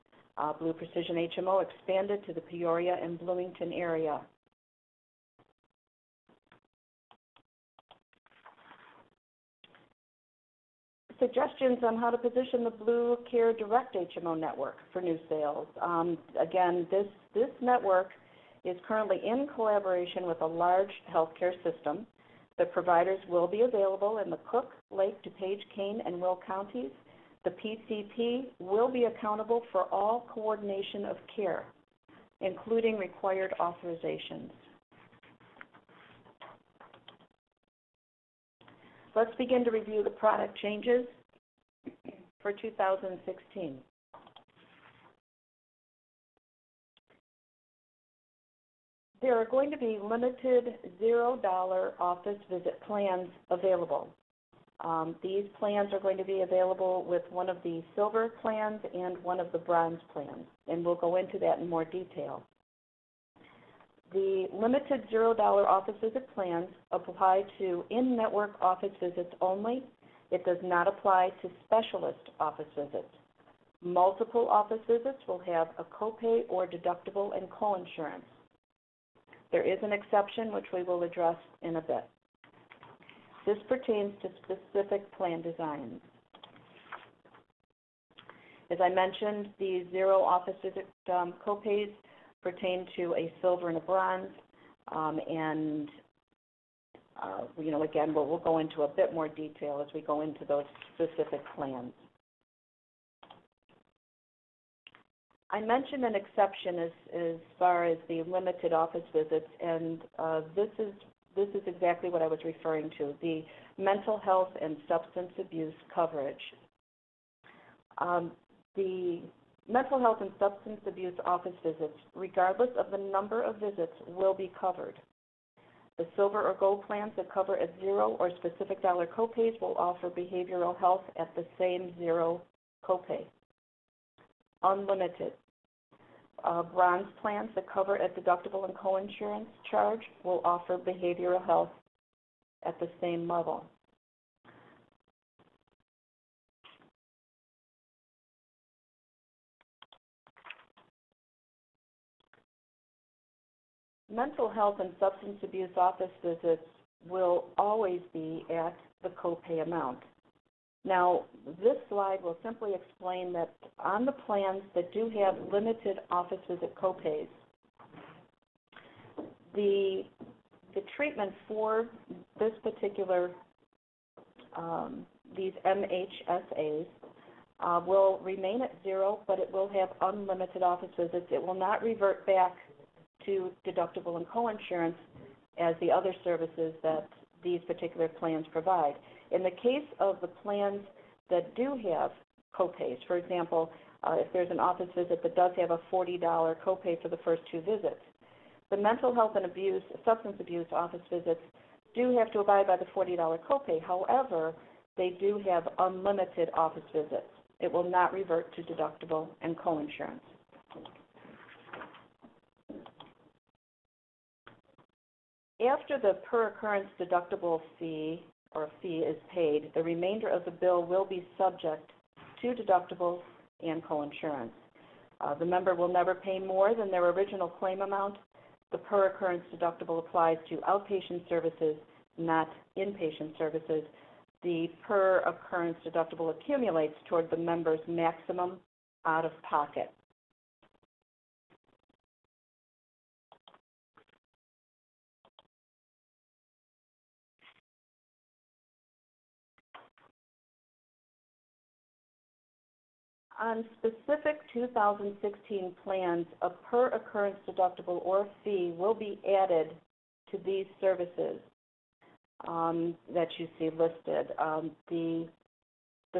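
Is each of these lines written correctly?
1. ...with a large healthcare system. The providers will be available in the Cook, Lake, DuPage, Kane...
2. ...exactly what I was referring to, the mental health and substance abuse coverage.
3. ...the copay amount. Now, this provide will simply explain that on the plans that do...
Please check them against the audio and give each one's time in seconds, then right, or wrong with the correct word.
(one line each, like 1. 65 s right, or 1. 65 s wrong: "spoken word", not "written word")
1. 20 s right
2. 111 s right
3. 159 s wrong: "slide", not "provide".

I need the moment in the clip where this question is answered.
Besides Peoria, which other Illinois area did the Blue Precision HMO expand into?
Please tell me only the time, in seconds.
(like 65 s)
3 s.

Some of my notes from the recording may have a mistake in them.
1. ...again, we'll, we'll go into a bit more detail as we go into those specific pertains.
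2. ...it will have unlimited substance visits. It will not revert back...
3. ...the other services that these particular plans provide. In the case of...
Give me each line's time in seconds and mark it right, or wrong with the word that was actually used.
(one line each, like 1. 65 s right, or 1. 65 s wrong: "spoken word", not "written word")
1. 97 s wrong: "plans", not "pertains"
2. 179 s wrong: "office", not "substance"
3. 185 s right.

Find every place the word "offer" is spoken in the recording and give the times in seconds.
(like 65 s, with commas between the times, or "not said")
129 s, 140 s.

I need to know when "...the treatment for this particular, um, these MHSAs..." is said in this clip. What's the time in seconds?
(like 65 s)
170 s.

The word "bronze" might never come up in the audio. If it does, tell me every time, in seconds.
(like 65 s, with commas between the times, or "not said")
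59 s, 93 s, 136 s.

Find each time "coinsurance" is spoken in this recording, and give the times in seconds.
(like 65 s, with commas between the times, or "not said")
77 s, 138 s, 184 s, 209 s, 223 s.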